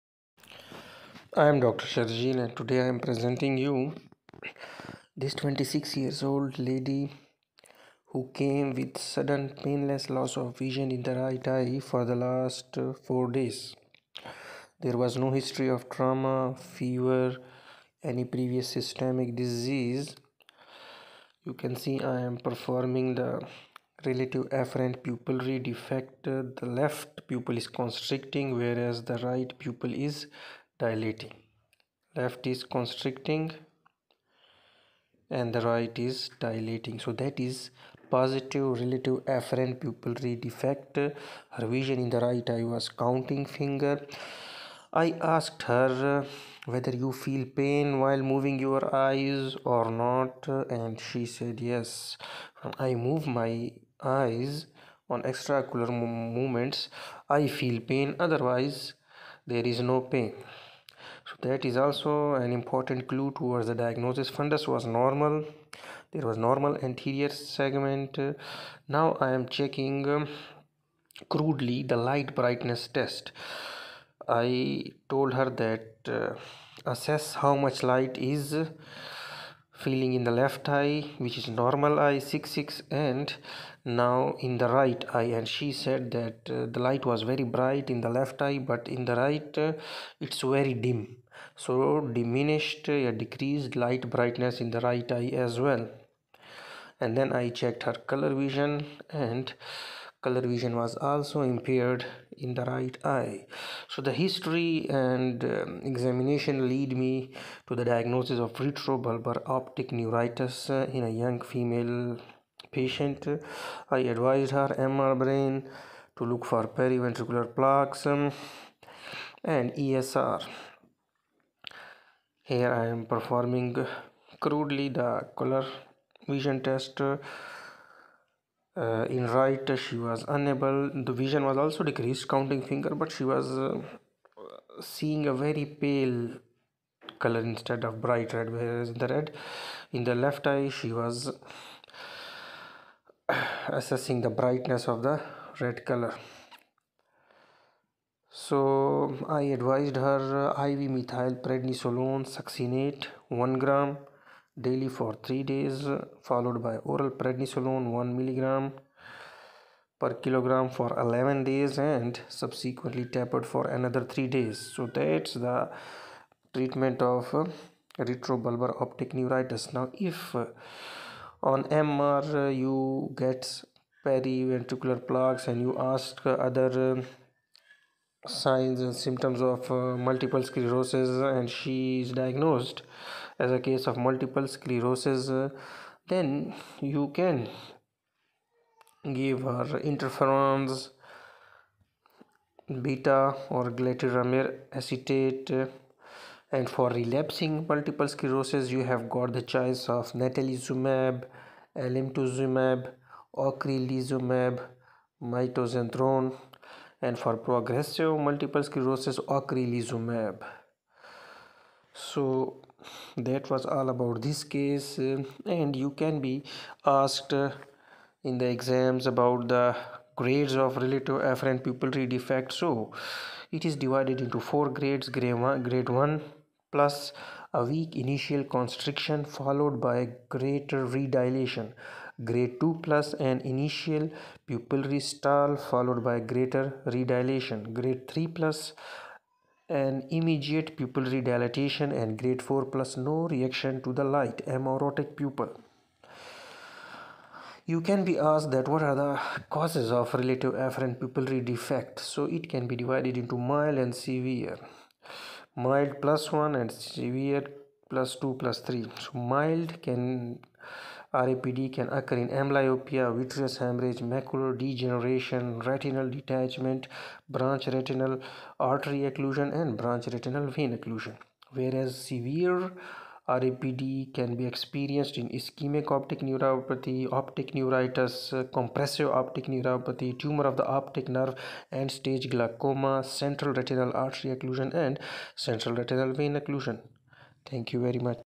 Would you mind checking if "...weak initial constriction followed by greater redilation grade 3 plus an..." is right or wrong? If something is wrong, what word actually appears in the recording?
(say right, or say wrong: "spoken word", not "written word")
wrong: "2", not "3".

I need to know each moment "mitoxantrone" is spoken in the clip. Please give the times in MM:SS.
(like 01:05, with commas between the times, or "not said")
03:25.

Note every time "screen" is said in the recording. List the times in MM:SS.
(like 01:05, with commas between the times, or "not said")
not said.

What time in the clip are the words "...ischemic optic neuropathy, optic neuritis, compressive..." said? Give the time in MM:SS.
04:35.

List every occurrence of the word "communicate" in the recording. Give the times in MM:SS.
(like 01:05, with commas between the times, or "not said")
not said.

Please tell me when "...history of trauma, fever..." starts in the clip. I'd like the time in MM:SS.
00:15.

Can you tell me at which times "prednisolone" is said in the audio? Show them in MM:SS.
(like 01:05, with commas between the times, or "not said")
02:31, 02:37.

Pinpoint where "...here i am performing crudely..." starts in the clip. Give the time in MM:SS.
02:02.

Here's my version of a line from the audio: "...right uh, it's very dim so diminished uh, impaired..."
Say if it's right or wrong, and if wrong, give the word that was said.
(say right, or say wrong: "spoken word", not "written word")
wrong: "decreased", not "impaired".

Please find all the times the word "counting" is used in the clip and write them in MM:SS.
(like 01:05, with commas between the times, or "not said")
00:43, 02:12.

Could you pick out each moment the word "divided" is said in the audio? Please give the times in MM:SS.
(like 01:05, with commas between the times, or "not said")
03:43, 04:12.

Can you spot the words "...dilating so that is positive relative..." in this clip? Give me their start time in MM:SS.
00:36.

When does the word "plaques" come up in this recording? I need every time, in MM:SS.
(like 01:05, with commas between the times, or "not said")
01:57, 02:55.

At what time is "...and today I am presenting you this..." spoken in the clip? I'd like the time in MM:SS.
00:02.